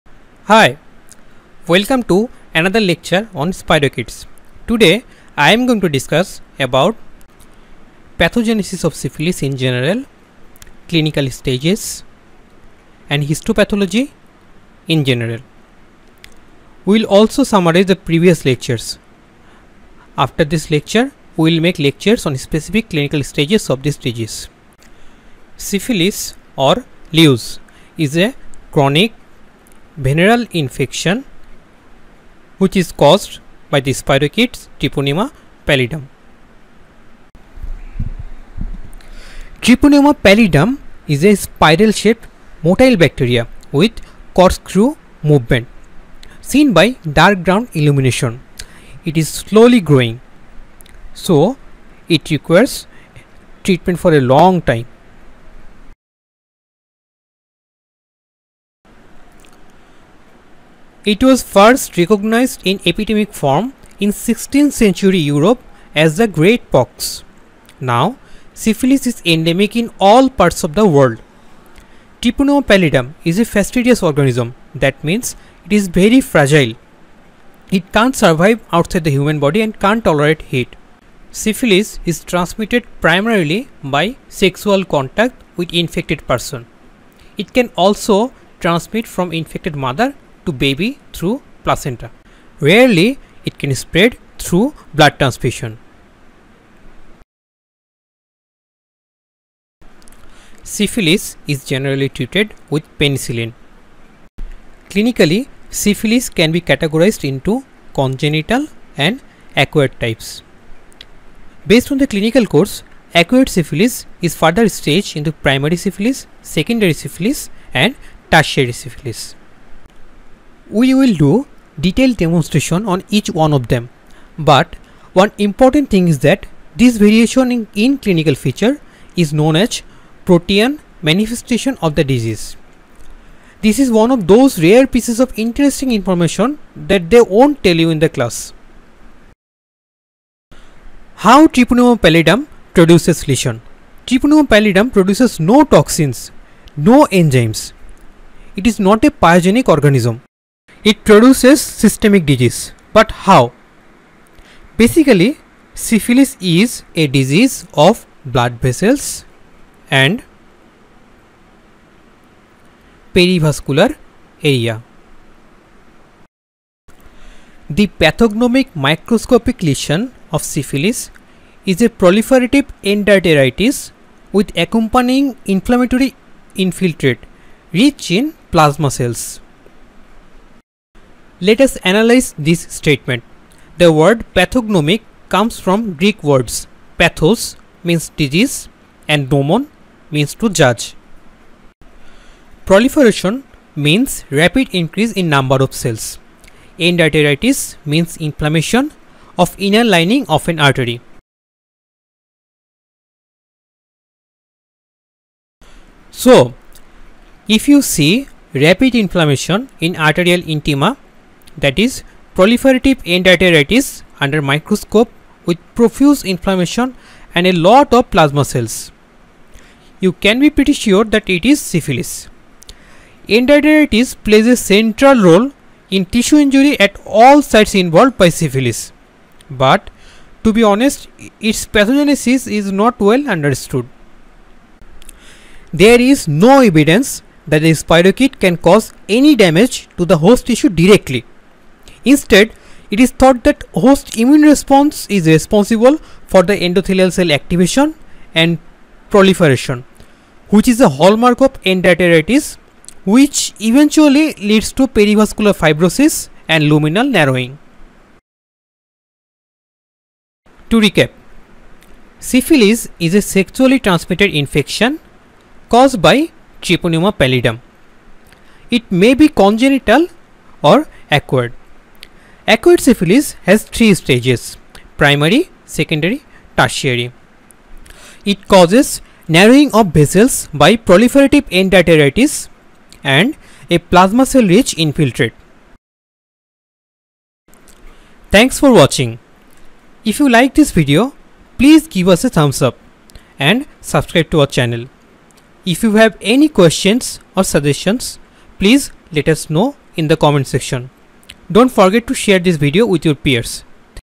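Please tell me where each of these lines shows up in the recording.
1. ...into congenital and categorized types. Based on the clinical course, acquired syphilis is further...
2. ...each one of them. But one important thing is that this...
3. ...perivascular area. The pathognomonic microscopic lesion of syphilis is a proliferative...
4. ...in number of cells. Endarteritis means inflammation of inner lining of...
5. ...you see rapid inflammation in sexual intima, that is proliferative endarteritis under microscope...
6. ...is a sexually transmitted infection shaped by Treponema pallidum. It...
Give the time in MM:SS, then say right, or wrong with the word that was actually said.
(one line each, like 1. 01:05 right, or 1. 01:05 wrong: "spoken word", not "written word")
1. 01:47 wrong: "acquired", not "categorized"
2. 02:03 right
3. 02:43 right
4. 03:15 right
5. 03:27 wrong: "arterial", not "sexual"
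6. 04:22 wrong: "caused", not "shaped".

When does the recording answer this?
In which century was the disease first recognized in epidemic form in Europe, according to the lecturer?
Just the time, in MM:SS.
01:04.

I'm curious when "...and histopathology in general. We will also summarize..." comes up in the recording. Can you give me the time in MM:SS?
00:13.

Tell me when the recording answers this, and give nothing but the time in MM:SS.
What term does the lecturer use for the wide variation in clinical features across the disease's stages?
02:10.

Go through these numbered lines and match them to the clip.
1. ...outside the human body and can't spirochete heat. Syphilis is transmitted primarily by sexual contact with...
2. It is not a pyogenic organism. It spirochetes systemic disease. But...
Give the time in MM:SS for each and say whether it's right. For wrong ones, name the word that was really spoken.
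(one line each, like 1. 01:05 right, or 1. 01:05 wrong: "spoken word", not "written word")
1. 01:18 wrong: "tolerate", not "spirochete"
2. 02:28 wrong: "produces", not "spirochetes".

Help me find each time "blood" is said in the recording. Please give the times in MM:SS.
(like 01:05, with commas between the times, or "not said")
01:34, 02:38.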